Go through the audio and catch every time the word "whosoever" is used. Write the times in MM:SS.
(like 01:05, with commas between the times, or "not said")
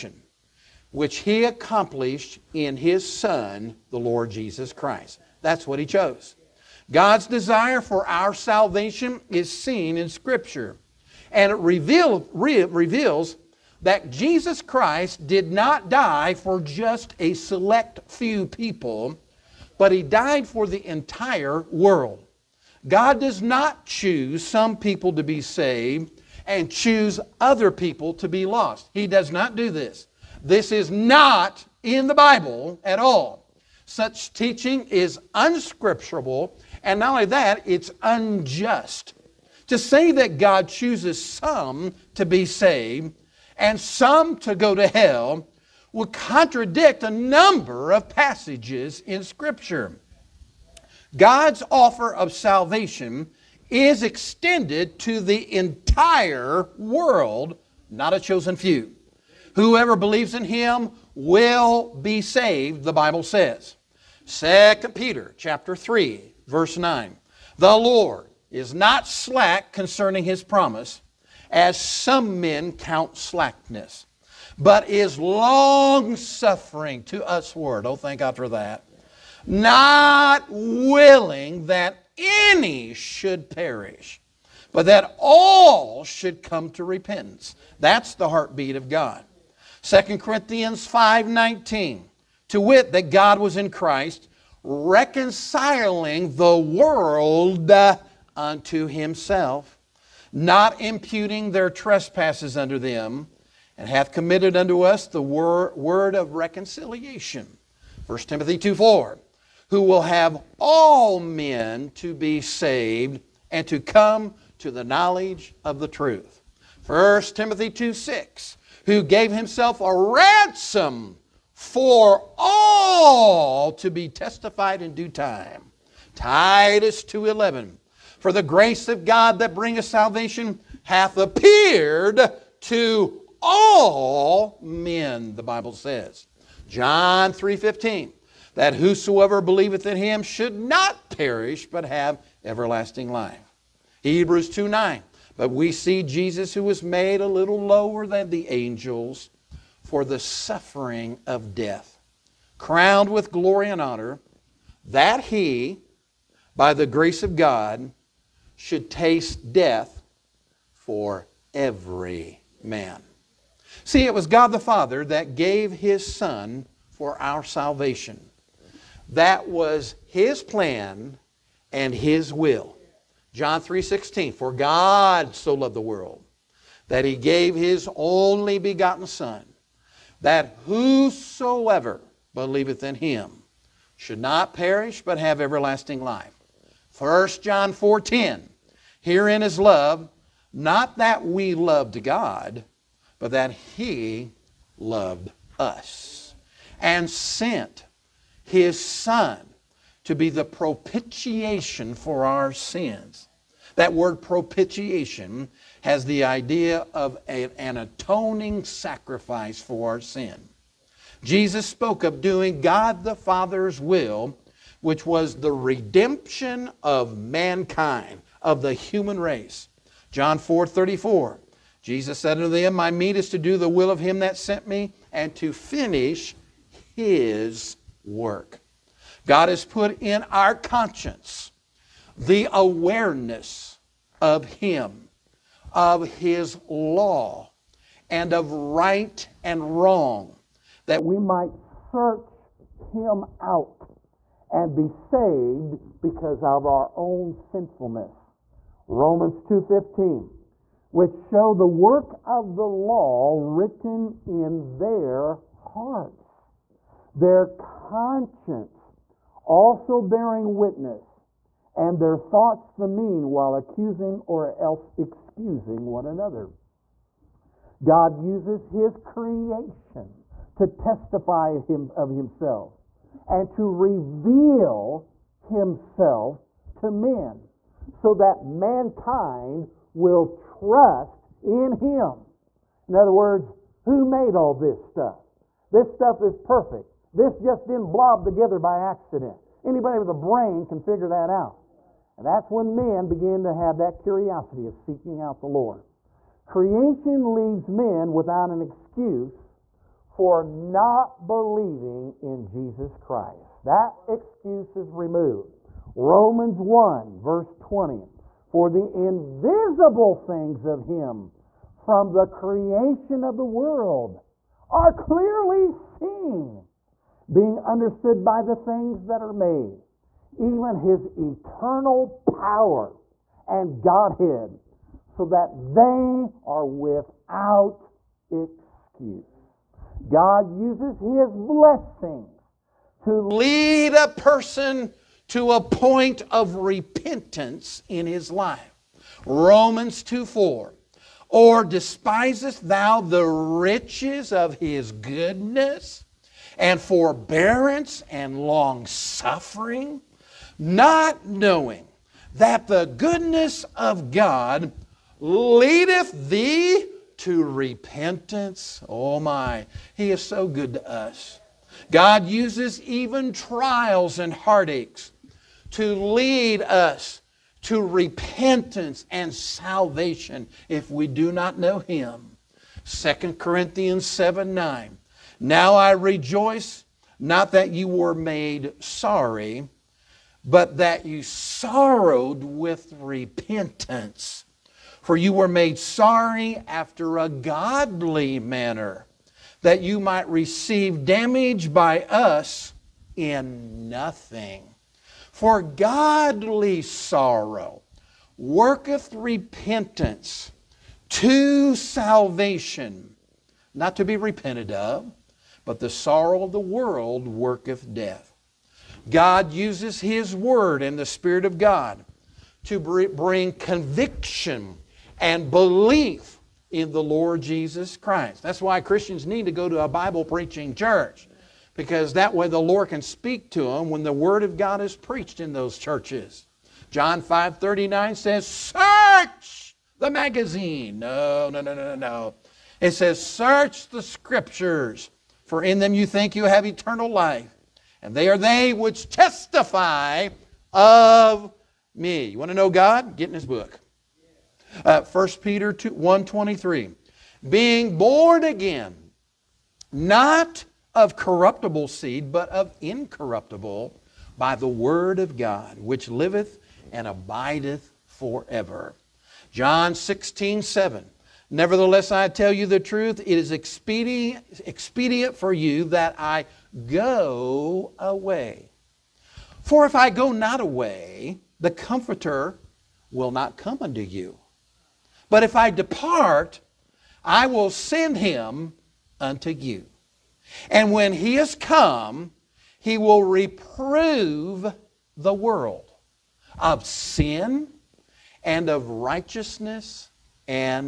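02:18, 03:00.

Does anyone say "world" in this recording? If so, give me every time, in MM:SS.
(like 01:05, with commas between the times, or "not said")
00:21, 00:56, 01:36, 02:55, 05:13, 06:46, 08:05.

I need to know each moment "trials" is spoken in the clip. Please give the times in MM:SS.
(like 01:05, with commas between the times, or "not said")
06:03.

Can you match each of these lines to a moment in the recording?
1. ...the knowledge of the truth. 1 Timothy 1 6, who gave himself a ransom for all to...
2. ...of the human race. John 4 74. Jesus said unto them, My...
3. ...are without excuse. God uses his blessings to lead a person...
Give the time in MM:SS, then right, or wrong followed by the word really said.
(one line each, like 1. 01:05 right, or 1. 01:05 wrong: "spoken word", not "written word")
1. 01:54 wrong: "2", not "1"
2. 03:38 wrong: "34", not "74"
3. 05:26 right.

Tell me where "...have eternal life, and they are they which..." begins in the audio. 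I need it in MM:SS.
07:16.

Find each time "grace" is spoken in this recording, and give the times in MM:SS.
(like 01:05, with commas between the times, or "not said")
02:08, 02:36.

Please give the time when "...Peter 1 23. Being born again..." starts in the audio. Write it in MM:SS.
07:25.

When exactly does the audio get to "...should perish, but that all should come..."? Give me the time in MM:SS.
01:22.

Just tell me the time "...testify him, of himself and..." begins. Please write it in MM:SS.
04:30.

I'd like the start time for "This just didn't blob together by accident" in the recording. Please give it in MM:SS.
04:47.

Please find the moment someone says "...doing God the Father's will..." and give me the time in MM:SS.
03:32.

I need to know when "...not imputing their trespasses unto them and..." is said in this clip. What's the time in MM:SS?
01:40.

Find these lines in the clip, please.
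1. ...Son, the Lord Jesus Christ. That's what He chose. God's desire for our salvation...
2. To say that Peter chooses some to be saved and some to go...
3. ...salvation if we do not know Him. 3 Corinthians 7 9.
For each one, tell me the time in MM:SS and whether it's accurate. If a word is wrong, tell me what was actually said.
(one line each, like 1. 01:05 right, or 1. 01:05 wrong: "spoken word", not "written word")
1. 00:03 right
2. 00:39 wrong: "God", not "Peter"
3. 06:09 wrong: "2", not "3".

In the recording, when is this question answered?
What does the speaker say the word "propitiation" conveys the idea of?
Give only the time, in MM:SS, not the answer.
03:27.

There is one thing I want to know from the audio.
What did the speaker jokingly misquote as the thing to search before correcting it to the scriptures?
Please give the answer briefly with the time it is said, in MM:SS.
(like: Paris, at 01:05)
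The magazine, at 07:09.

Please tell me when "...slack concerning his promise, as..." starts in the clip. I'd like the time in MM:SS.
01:09.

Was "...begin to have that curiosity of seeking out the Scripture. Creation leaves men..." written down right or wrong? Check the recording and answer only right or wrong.
wrong.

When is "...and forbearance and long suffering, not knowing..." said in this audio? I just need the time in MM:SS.
05:46.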